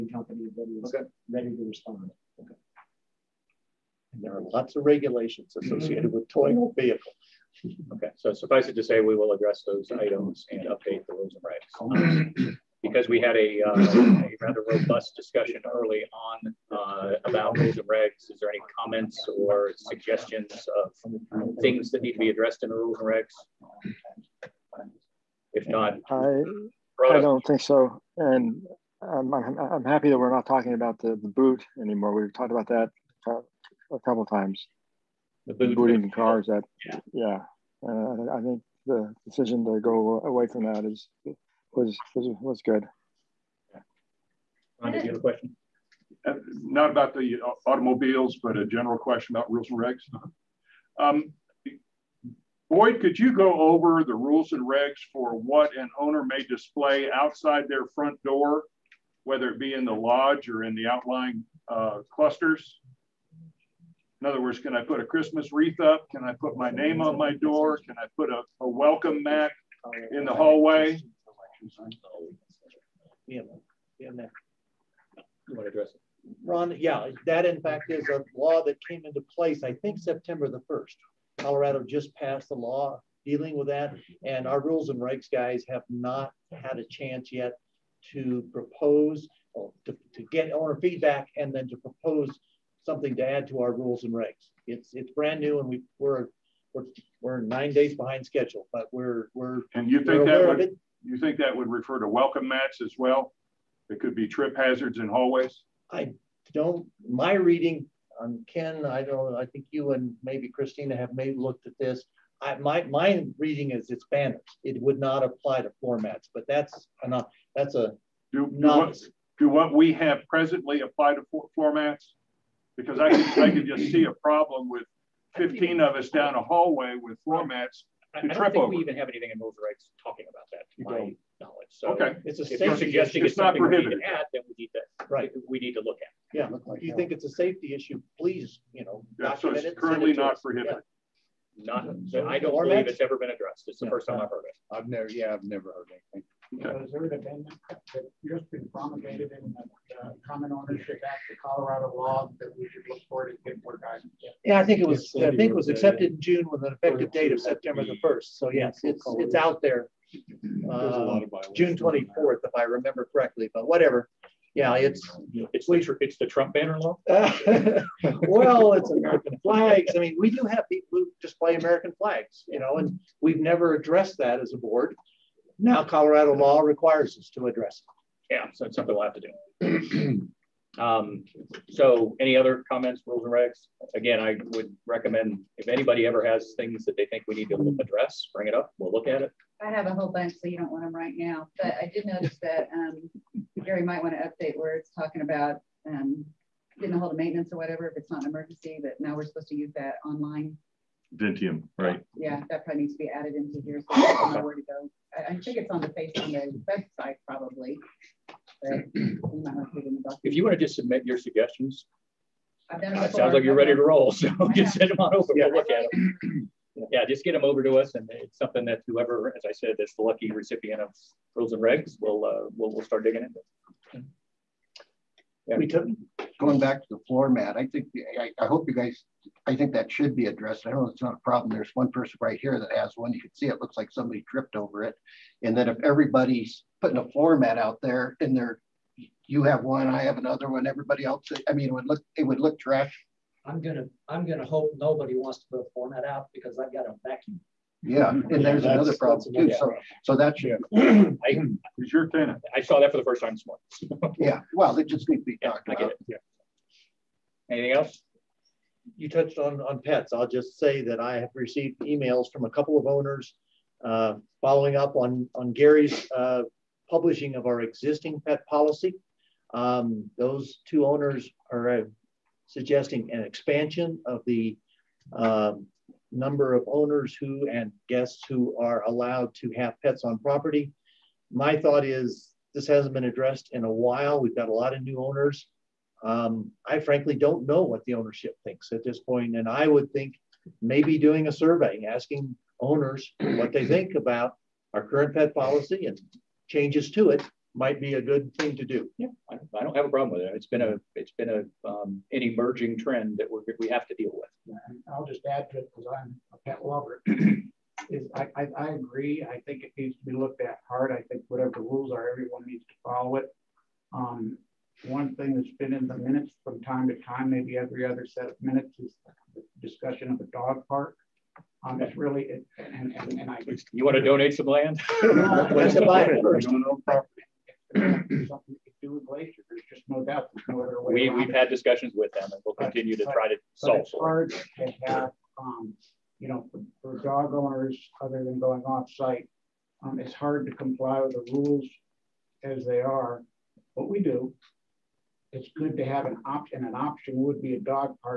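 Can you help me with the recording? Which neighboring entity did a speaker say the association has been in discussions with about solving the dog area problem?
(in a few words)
Glacier.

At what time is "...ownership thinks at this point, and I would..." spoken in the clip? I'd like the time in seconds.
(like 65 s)
287 s.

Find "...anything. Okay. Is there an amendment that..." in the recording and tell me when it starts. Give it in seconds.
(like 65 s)
146 s.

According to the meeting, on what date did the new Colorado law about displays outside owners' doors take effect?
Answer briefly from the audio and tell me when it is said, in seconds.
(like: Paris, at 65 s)
September 1st, at 79 s.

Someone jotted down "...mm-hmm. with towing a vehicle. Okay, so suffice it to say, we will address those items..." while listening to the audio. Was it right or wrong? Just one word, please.
right.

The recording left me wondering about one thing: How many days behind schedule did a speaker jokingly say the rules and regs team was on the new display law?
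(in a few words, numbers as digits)
9.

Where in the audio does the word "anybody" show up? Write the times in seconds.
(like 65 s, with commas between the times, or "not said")
185 s.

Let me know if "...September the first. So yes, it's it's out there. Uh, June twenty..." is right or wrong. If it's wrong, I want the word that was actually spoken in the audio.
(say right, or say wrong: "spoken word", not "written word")
right.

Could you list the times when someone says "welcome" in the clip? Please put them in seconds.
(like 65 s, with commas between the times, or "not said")
68 s, 102 s.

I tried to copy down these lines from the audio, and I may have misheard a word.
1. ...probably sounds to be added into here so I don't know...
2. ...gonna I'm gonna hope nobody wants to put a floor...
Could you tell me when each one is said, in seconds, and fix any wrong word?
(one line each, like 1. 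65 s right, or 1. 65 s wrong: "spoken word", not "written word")
1. 202 s wrong: "needs", not "sounds"
2. 243 s right.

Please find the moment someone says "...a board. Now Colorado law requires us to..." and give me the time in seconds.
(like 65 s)
174 s.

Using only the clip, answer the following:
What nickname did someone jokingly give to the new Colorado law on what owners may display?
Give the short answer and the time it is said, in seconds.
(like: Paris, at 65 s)
Trump banner law, at 166 s.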